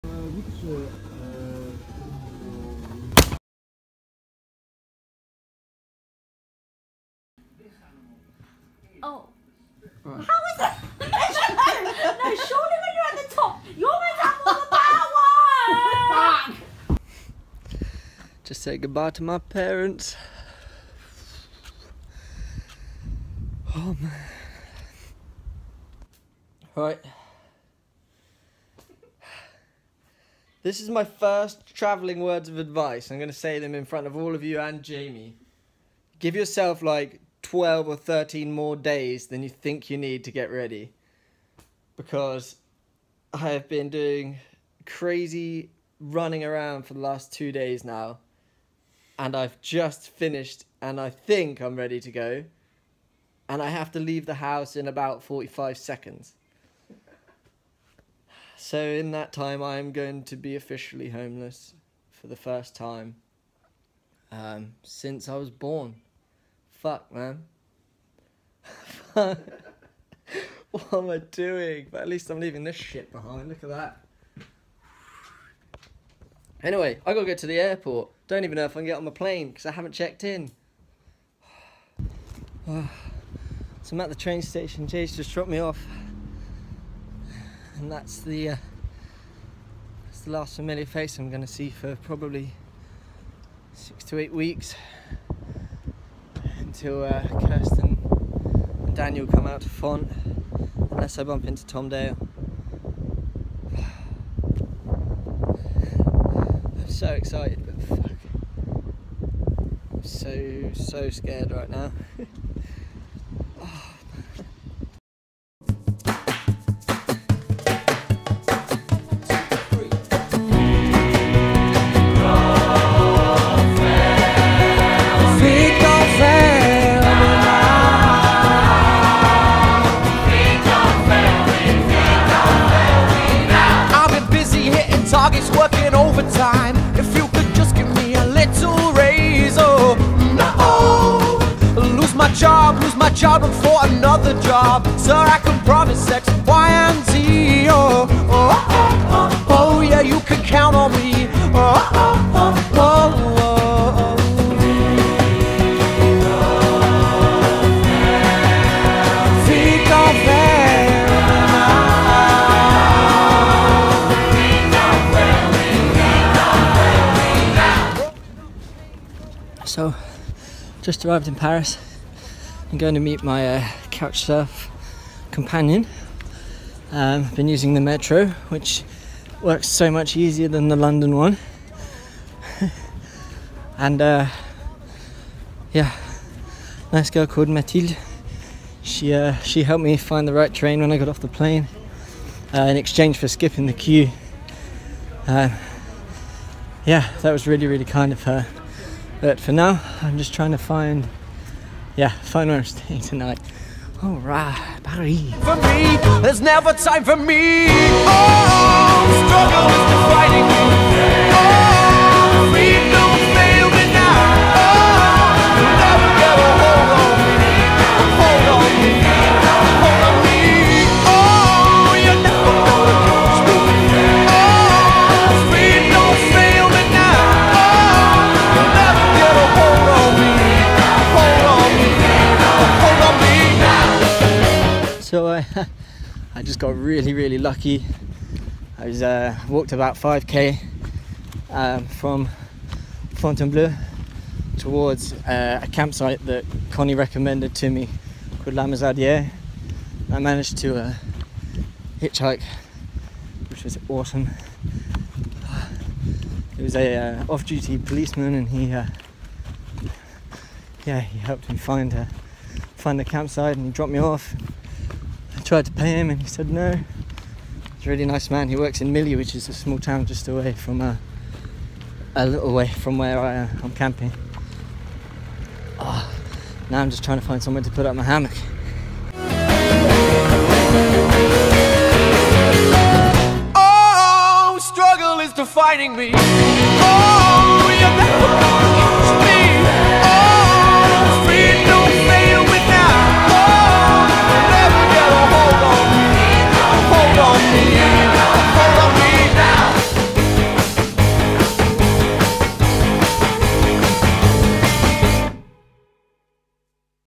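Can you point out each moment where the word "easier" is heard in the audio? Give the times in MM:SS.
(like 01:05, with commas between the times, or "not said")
03:00.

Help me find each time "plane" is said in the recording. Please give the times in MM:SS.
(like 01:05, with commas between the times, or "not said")
01:19, 03:11.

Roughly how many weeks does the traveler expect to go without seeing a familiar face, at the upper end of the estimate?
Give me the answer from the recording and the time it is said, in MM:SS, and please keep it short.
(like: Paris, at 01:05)
8, at 01:34.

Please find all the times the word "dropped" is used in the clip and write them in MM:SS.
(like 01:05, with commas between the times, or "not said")
01:25, 04:23.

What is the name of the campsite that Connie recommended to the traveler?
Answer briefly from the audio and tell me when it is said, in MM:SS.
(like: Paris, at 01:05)
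La Musardière, at 04:08.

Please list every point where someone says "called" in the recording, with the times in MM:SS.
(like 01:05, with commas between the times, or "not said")
03:07, 04:08.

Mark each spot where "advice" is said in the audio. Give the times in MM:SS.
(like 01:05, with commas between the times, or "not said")
00:32.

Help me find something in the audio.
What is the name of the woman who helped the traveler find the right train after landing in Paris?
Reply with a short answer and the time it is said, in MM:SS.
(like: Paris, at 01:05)
Mathilde, at 03:07.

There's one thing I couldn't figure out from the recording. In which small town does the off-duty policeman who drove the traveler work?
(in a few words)
Milly.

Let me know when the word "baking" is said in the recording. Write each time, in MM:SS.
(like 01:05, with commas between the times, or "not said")
not said.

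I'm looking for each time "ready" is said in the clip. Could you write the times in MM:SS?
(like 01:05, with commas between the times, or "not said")
00:40, 00:51.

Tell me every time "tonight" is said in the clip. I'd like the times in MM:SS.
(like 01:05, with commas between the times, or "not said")
03:23.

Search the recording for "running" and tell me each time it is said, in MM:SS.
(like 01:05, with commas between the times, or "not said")
00:45.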